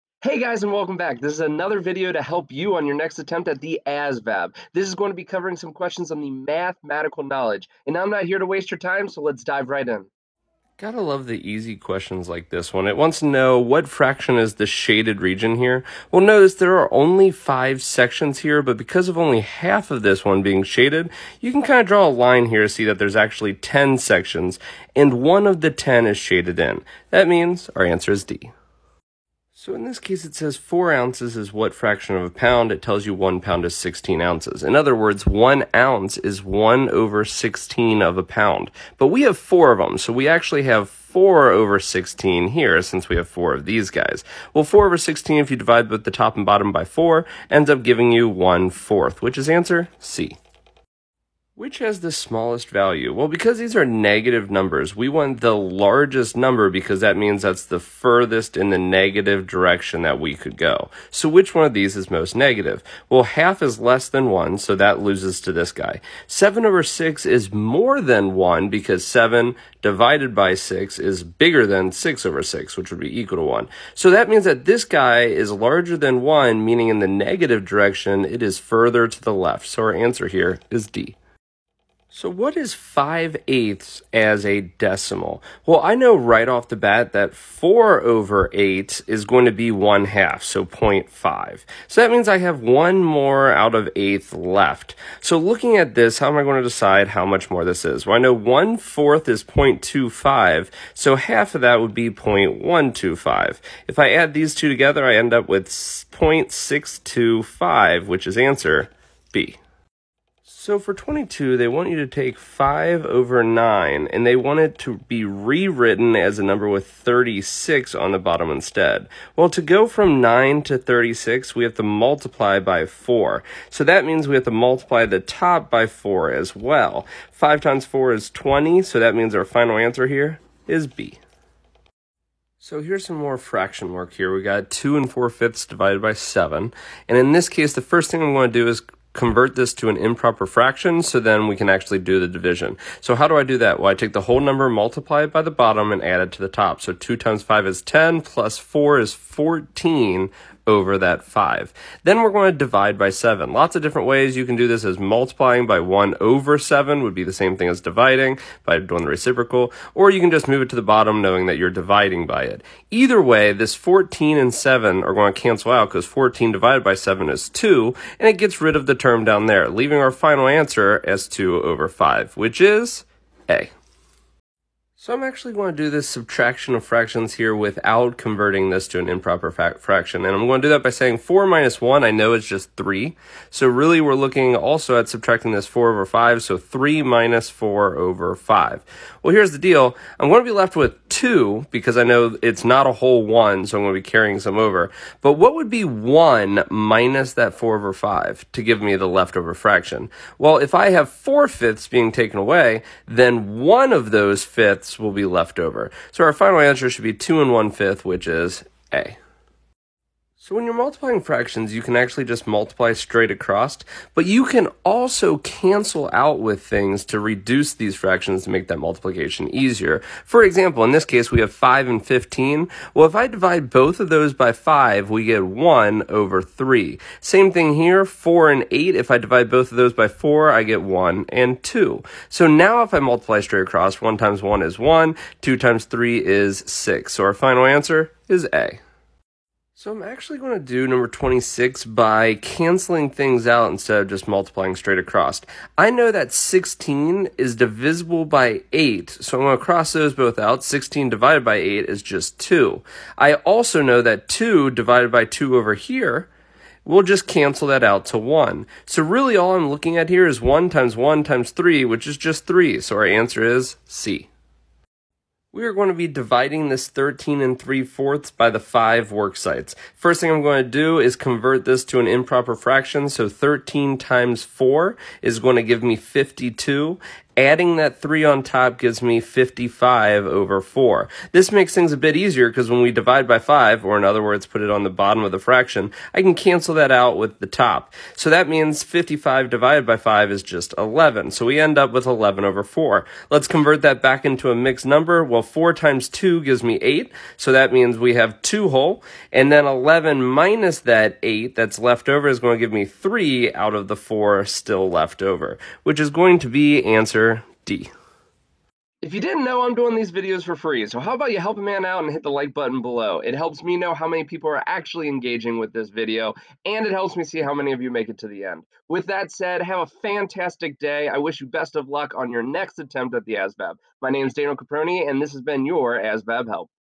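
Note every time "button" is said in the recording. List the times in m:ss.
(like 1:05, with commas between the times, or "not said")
5:12.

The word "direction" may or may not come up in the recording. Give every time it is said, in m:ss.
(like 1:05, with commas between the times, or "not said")
0:59, 1:17.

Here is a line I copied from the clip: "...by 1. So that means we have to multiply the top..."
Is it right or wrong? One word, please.
wrong.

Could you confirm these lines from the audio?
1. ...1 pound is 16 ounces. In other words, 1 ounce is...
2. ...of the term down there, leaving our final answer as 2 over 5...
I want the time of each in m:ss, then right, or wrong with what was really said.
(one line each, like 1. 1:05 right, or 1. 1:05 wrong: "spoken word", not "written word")
1. 0:33 right
2. 2:48 right.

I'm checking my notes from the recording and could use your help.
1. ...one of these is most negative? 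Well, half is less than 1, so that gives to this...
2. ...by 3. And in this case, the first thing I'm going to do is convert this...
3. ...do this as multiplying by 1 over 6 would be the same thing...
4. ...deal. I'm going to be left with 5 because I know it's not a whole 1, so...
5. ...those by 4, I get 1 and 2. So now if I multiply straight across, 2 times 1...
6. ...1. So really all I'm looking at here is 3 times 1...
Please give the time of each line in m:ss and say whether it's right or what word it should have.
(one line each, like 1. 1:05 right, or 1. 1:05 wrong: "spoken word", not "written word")
1. 1:01 wrong: "loses", not "gives"
2. 2:16 wrong: "7", not "3"
3. 2:34 wrong: "7", not "6"
4. 3:09 wrong: "2", not "5"
5. 3:49 wrong: "1", not "2"
6. 4:18 wrong: "1", not "3".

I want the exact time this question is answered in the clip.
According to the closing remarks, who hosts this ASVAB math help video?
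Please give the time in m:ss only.
5:24.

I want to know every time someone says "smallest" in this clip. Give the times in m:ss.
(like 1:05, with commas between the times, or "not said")
0:52.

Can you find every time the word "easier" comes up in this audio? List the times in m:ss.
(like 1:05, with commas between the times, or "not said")
3:39, 4:42.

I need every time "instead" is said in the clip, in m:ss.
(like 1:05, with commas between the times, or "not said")
1:58, 4:03.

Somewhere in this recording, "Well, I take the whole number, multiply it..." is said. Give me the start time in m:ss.
2:23.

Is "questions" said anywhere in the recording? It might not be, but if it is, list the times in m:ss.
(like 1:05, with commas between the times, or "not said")
0:05, 0:11.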